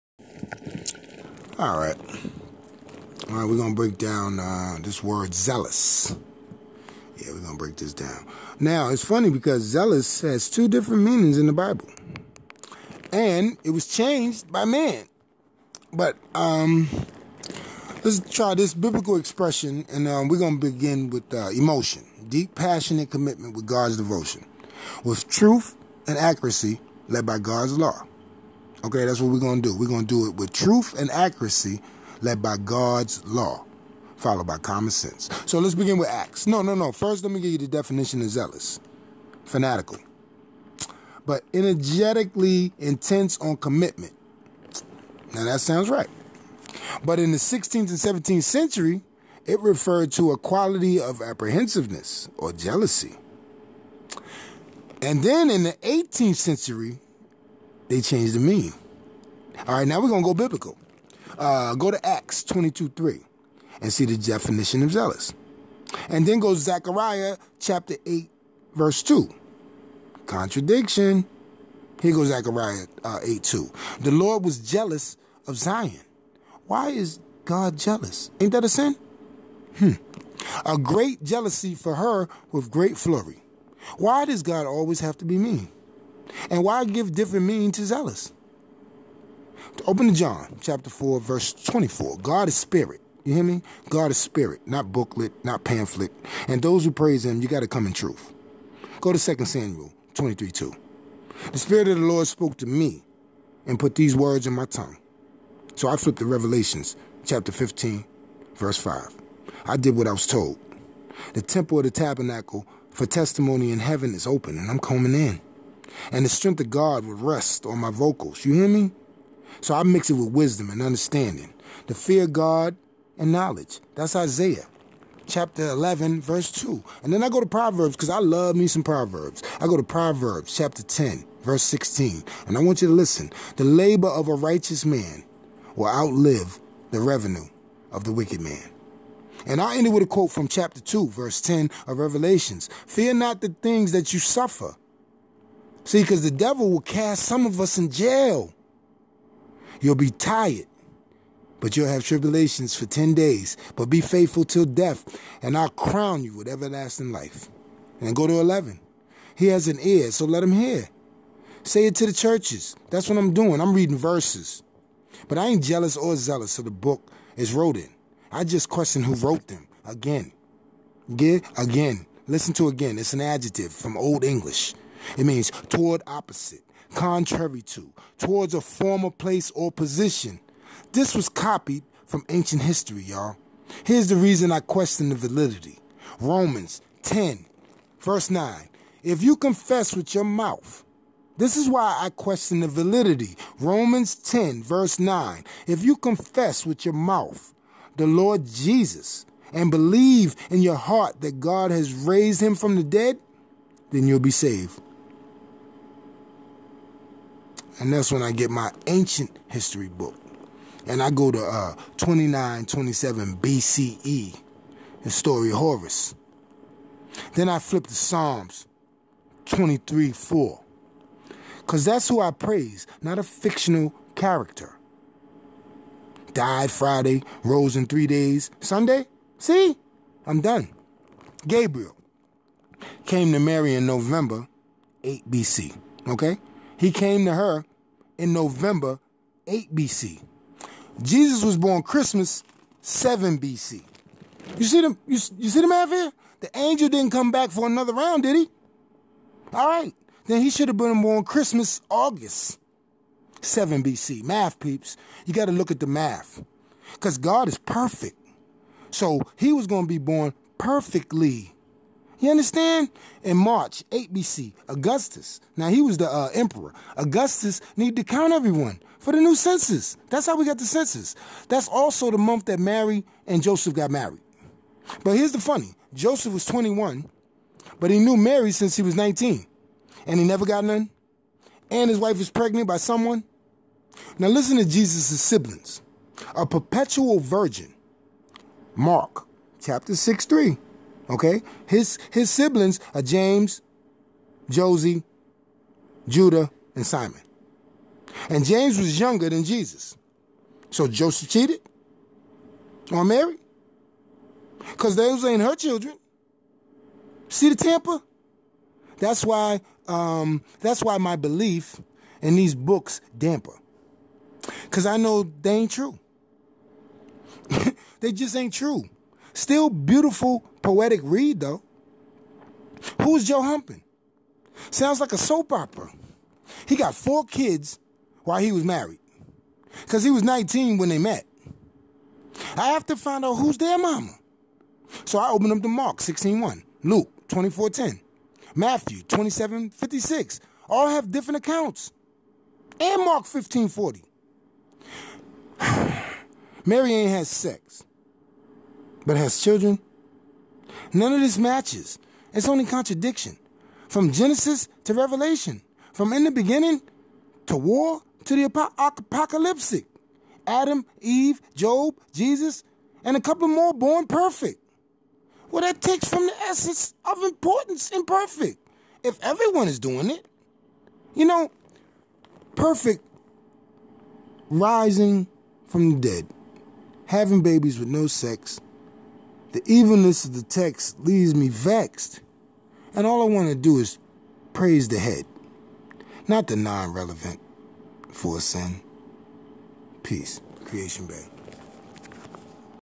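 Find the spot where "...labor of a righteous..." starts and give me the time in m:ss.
2:13.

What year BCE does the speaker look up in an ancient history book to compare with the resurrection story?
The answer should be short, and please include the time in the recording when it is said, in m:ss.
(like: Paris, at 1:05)
2927 BCE, at 3:31.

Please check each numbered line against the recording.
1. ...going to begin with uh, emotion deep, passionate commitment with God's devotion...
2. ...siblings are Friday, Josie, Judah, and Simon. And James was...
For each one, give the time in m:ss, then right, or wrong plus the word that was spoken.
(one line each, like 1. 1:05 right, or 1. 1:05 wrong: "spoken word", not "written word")
1. 0:20 right
2. 4:52 wrong: "James", not "Friday".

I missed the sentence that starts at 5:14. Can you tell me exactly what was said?
Cause I know they ain't true.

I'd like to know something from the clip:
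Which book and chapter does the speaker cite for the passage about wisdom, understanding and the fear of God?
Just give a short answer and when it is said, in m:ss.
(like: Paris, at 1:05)
Isaiah 11, at 2:04.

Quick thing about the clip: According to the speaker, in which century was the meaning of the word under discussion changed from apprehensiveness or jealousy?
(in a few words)
18th century.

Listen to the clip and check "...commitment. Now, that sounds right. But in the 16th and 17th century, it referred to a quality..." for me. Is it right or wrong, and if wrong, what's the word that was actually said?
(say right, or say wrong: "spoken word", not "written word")
right.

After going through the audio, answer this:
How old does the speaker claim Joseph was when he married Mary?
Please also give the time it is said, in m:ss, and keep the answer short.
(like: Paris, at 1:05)
21, at 4:36.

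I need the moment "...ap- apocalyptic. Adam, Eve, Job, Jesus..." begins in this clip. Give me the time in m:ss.
5:58.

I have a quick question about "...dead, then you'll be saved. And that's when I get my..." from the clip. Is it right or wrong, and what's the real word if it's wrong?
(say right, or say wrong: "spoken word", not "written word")
right.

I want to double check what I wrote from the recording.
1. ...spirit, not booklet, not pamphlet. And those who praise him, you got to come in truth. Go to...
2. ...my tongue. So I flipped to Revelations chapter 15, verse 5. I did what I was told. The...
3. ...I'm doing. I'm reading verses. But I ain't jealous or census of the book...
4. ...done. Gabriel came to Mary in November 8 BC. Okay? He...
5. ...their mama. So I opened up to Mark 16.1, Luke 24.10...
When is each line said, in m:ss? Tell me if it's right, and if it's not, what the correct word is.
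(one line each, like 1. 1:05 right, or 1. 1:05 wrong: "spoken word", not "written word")
1. 1:34 right
2. 1:44 right
3. 2:43 wrong: "zealous", not "census"
4. 3:50 right
5. 5:33 right.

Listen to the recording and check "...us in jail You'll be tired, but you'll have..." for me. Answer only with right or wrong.
right.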